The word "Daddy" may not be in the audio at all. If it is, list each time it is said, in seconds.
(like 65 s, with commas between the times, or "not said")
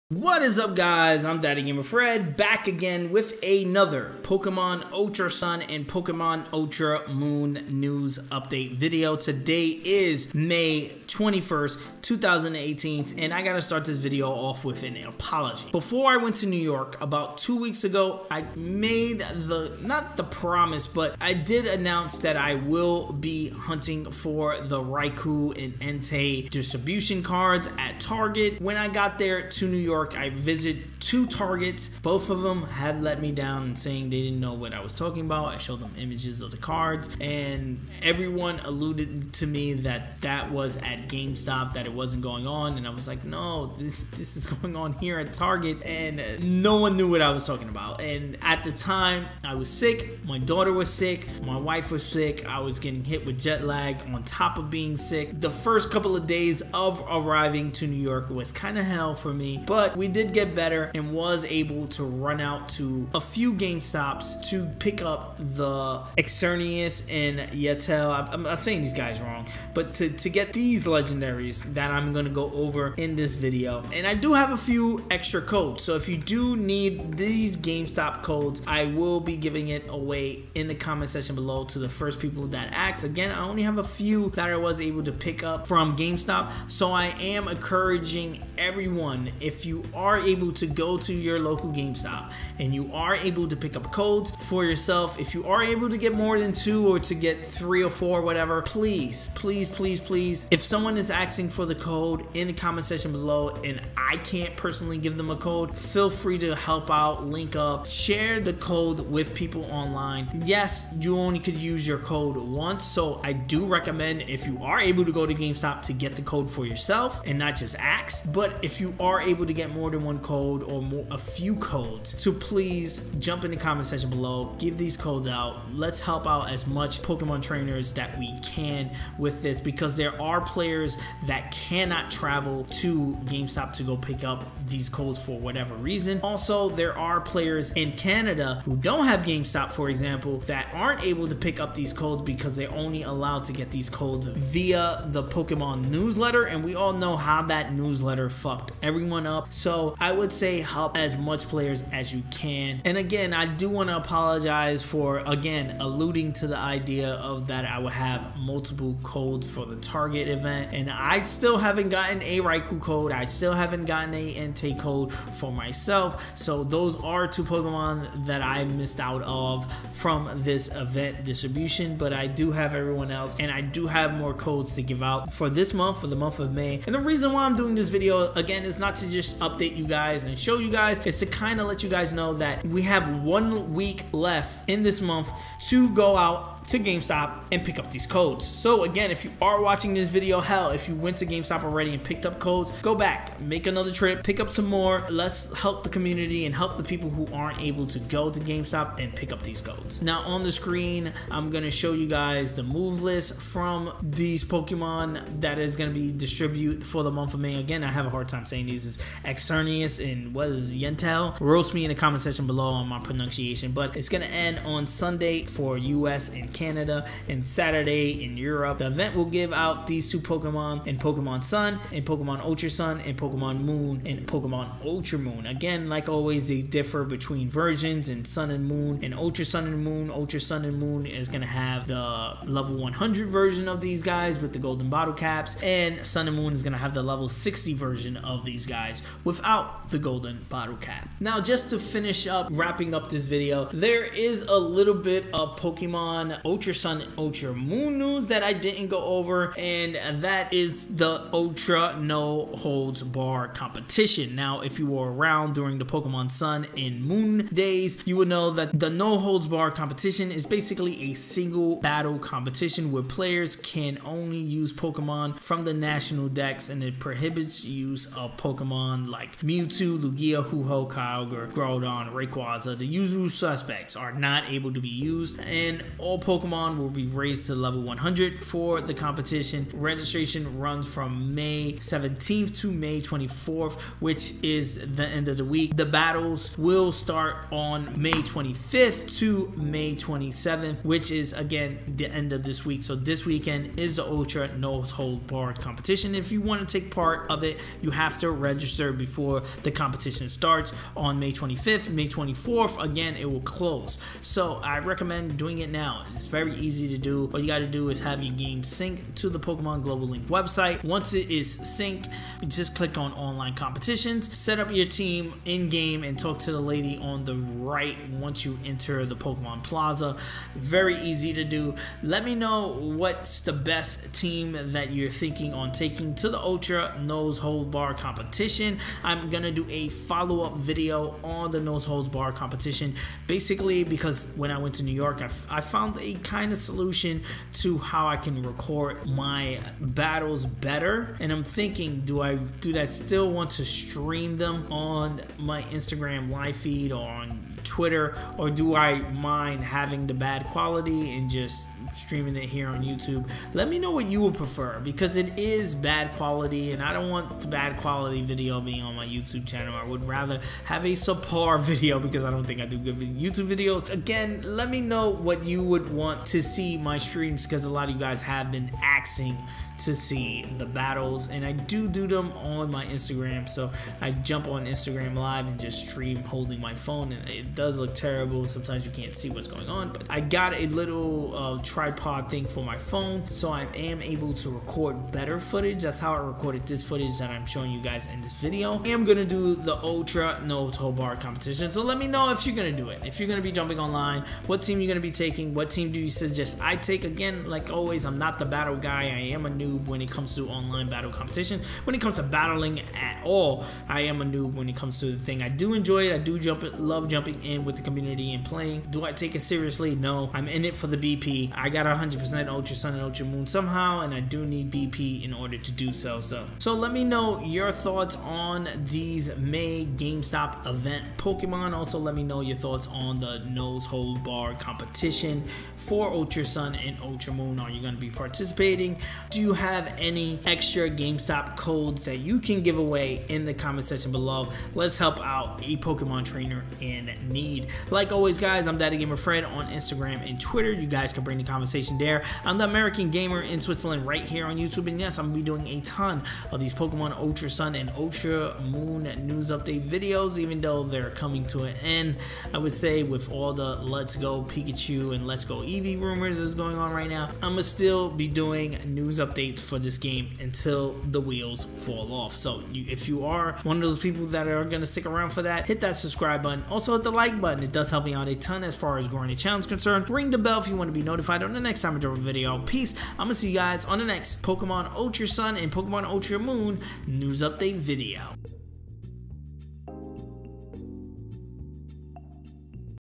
1 s, 438 s.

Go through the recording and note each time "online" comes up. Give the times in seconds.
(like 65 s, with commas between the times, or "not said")
109 s, 313 s, 393 s, 400 s.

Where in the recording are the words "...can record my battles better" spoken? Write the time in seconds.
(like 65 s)
338 s.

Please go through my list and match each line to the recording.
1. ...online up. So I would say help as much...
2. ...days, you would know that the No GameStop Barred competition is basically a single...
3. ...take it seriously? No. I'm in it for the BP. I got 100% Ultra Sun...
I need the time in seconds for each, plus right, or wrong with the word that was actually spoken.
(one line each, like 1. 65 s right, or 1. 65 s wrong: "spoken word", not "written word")
1. 148 s wrong: "everyone", not "online"
2. 257 s wrong: "Holds", not "GameStop"
3. 409 s right.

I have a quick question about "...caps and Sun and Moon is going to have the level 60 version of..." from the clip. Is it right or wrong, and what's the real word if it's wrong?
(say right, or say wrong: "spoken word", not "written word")
right.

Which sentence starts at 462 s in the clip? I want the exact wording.
So you, if you are one of those people that are going to stick around for that, hit that subscribe button.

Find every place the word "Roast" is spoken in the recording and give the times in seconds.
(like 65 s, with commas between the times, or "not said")
211 s.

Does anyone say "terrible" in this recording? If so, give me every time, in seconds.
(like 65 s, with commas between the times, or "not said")
377 s.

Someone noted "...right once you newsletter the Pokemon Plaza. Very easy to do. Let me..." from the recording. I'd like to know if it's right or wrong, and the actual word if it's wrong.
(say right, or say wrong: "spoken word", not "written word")
wrong: "enter", not "newsletter".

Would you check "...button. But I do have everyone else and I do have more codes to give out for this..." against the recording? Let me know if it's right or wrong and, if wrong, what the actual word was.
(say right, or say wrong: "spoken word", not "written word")
wrong: "distribution", not "button".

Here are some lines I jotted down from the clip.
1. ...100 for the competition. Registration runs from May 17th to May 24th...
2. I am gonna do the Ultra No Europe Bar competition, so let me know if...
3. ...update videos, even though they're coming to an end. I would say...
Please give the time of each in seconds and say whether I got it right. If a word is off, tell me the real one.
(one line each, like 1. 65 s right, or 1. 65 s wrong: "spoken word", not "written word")
1. 277 s right
2. 388 s wrong: "Toe", not "Europe"
3. 449 s right.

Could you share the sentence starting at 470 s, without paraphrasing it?
Ring the bell if you want to be notified on the next time I drop a video.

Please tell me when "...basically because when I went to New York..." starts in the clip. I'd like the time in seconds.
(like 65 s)
333 s.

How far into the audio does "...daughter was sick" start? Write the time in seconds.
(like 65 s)
50 s.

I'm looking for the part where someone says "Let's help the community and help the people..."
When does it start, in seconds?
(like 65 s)
195 s.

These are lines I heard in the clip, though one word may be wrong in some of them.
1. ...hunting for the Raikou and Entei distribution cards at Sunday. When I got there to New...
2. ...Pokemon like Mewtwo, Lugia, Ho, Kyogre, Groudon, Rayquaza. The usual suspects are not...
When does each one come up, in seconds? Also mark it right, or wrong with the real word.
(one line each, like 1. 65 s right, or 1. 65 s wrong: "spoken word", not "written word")
1. 23 s wrong: "Target", not "Sunday"
2. 268 s right.